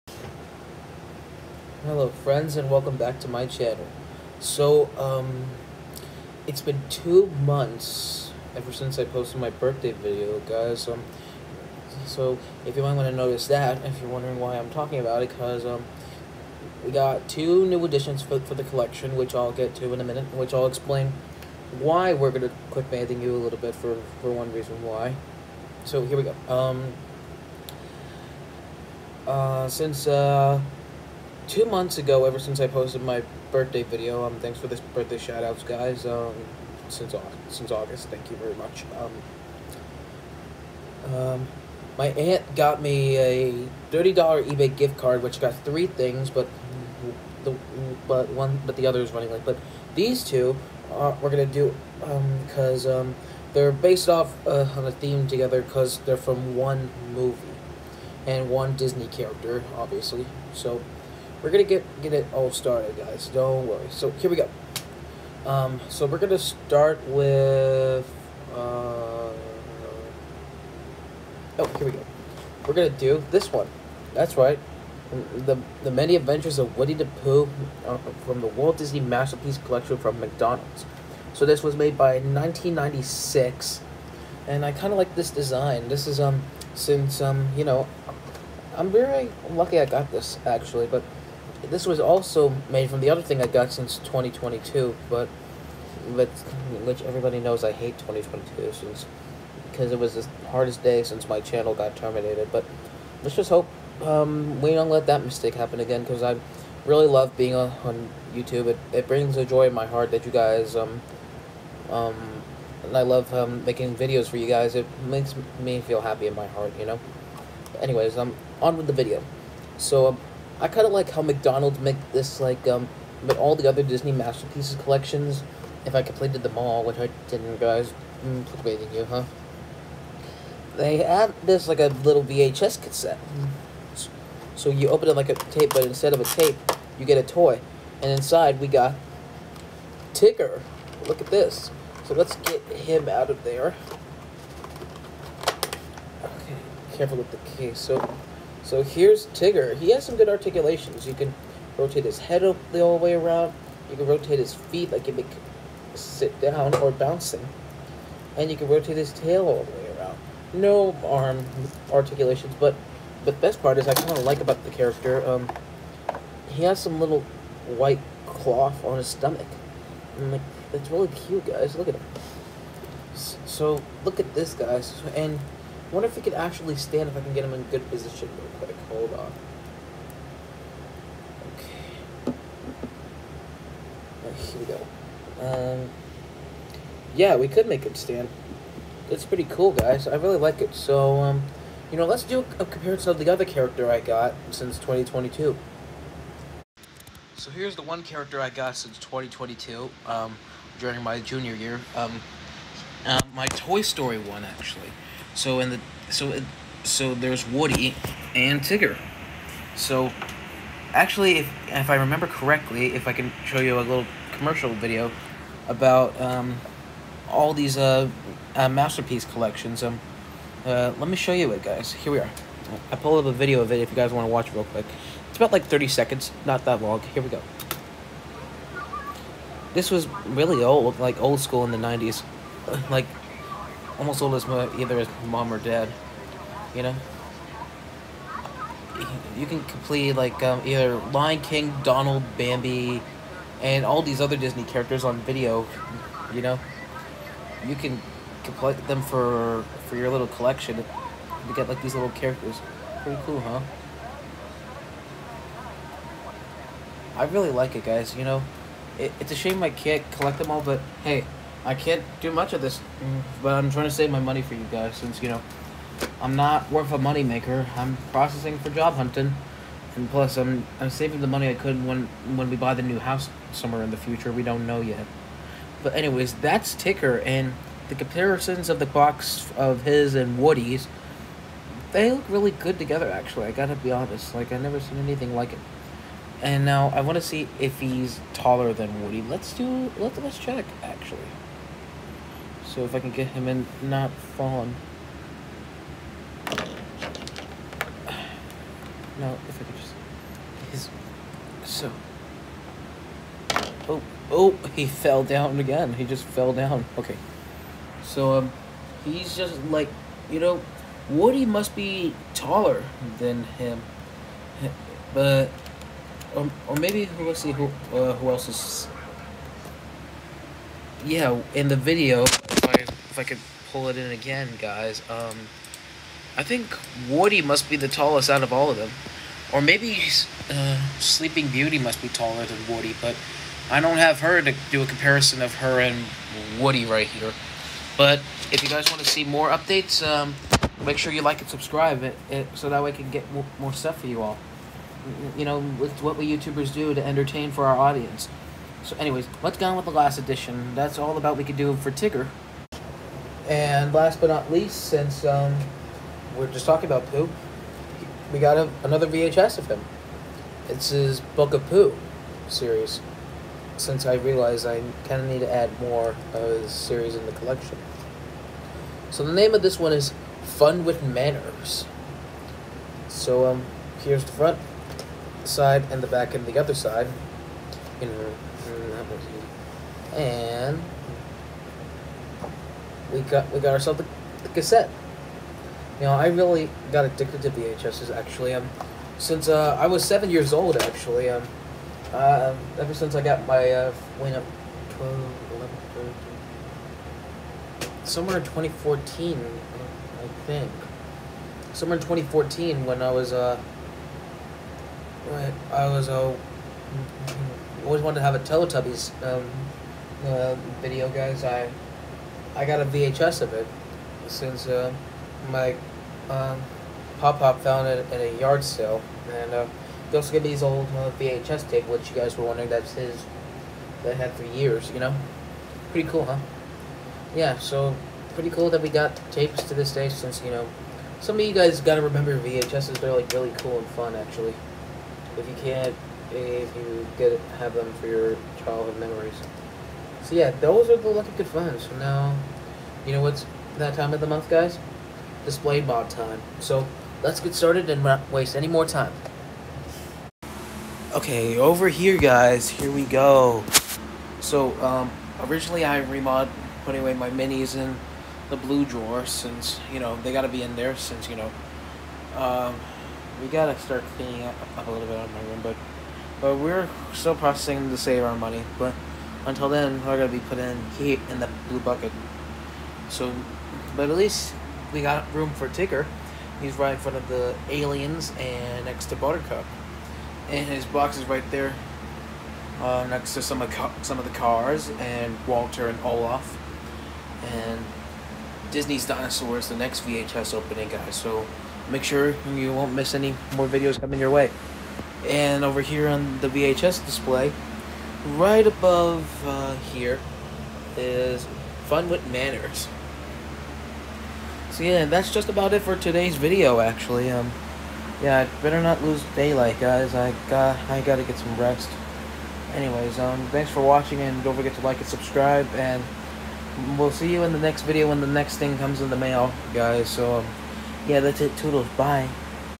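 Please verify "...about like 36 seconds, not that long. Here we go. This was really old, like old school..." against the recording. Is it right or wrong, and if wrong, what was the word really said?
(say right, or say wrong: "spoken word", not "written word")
wrong: "30", not "36".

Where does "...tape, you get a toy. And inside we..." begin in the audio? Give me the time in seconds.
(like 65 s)
136 s.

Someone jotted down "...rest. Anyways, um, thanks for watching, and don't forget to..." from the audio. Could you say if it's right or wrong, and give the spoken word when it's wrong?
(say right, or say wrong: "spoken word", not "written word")
right.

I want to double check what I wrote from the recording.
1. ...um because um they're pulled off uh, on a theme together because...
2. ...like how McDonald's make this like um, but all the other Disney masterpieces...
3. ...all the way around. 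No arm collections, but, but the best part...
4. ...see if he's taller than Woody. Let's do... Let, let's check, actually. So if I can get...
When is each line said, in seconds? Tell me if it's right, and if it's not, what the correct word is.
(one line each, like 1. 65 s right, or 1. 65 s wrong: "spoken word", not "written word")
1. 52 s wrong: "based", not "pulled"
2. 120 s right
3. 159 s wrong: "articulations", not "collections"
4. 287 s right.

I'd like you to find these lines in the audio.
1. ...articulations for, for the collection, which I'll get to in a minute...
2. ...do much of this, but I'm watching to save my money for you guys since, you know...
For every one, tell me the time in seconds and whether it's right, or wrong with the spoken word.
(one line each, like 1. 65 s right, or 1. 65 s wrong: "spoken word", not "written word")
1. 17 s wrong: "additions", not "articulations"
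2. 262 s wrong: "trying", not "watching".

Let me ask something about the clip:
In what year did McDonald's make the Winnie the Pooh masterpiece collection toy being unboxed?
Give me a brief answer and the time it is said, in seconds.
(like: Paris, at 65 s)
1996, at 82 s.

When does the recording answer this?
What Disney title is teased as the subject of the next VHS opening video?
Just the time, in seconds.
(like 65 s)
488 s.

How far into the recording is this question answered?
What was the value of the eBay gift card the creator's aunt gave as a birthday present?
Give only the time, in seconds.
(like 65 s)
43 s.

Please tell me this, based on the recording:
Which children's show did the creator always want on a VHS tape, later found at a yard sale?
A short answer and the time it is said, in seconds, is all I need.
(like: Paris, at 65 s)
Teletubbies, at 408 s.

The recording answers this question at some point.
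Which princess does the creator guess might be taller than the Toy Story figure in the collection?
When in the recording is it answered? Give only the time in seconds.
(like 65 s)
330 s.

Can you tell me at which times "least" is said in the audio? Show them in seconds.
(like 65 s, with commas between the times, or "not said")
354 s, 474 s.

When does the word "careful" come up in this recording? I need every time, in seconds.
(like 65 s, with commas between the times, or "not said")
146 s.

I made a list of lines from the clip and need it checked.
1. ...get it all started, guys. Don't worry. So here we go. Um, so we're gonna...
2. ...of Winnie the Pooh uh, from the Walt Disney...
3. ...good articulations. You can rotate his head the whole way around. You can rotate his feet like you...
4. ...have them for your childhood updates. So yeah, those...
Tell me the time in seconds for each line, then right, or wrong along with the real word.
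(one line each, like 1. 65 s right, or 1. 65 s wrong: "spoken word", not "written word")
1. 62 s right
2. 76 s right
3. 150 s right
4. 437 s wrong: "memories", not "updates".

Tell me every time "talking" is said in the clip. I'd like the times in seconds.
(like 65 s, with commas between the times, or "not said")
14 s, 356 s.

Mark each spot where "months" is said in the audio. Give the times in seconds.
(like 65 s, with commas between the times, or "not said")
7 s, 31 s, 444 s.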